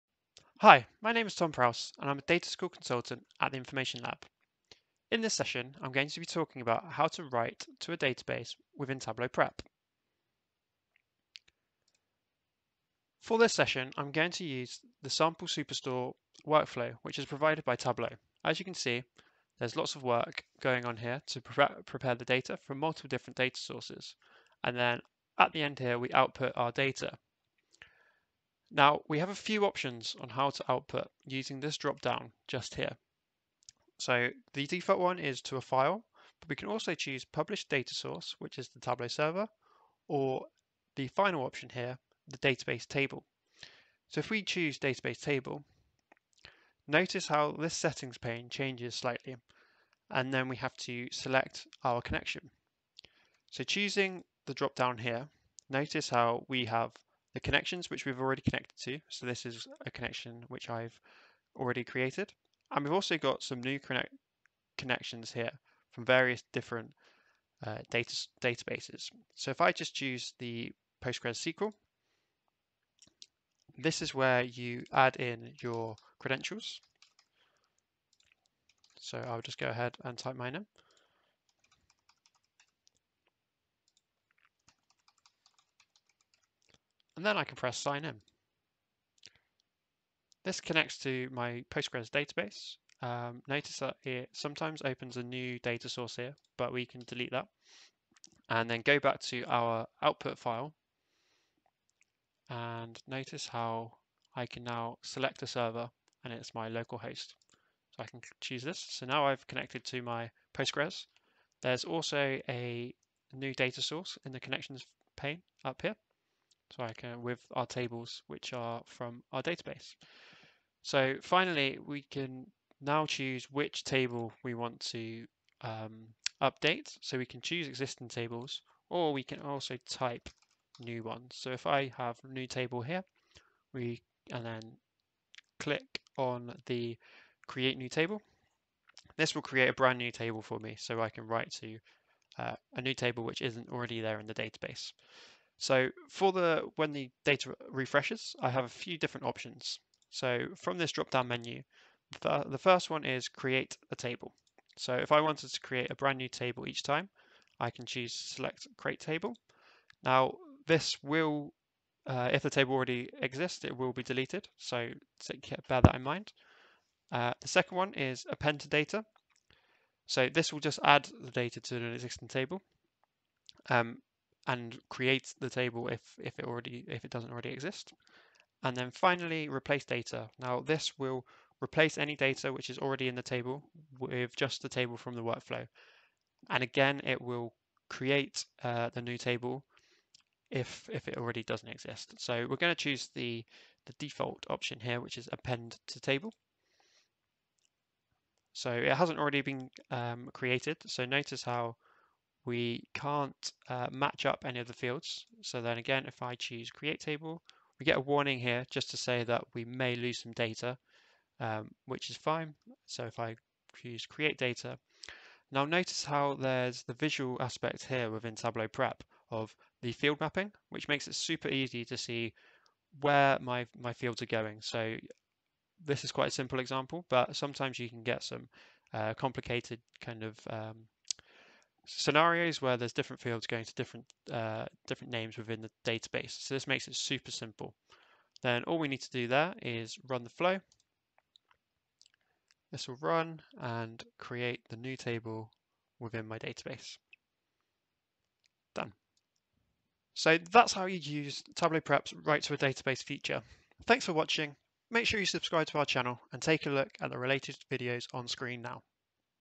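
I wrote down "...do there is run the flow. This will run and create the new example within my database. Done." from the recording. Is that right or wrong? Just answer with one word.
wrong.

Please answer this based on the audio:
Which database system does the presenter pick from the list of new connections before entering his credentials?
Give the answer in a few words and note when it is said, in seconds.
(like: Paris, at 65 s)
Postgres SQL, at 71 s.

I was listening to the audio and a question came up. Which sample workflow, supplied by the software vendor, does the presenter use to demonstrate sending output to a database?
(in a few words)
Sample Superstore.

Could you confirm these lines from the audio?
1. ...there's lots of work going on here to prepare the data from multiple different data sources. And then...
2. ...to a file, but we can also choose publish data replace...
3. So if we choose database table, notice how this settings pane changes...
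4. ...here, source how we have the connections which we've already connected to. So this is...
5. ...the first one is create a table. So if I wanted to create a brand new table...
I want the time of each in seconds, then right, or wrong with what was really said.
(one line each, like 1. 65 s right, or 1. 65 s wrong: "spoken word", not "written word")
1. 19 s right
2. 35 s wrong: "source", not "replace"
3. 44 s right
4. 54 s wrong: "notice", not "source"
5. 152 s right.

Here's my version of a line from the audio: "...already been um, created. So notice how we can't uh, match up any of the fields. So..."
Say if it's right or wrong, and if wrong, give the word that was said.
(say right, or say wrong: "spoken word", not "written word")
right.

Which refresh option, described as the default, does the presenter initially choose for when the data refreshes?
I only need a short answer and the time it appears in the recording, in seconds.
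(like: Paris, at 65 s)
Append to table, at 195 s.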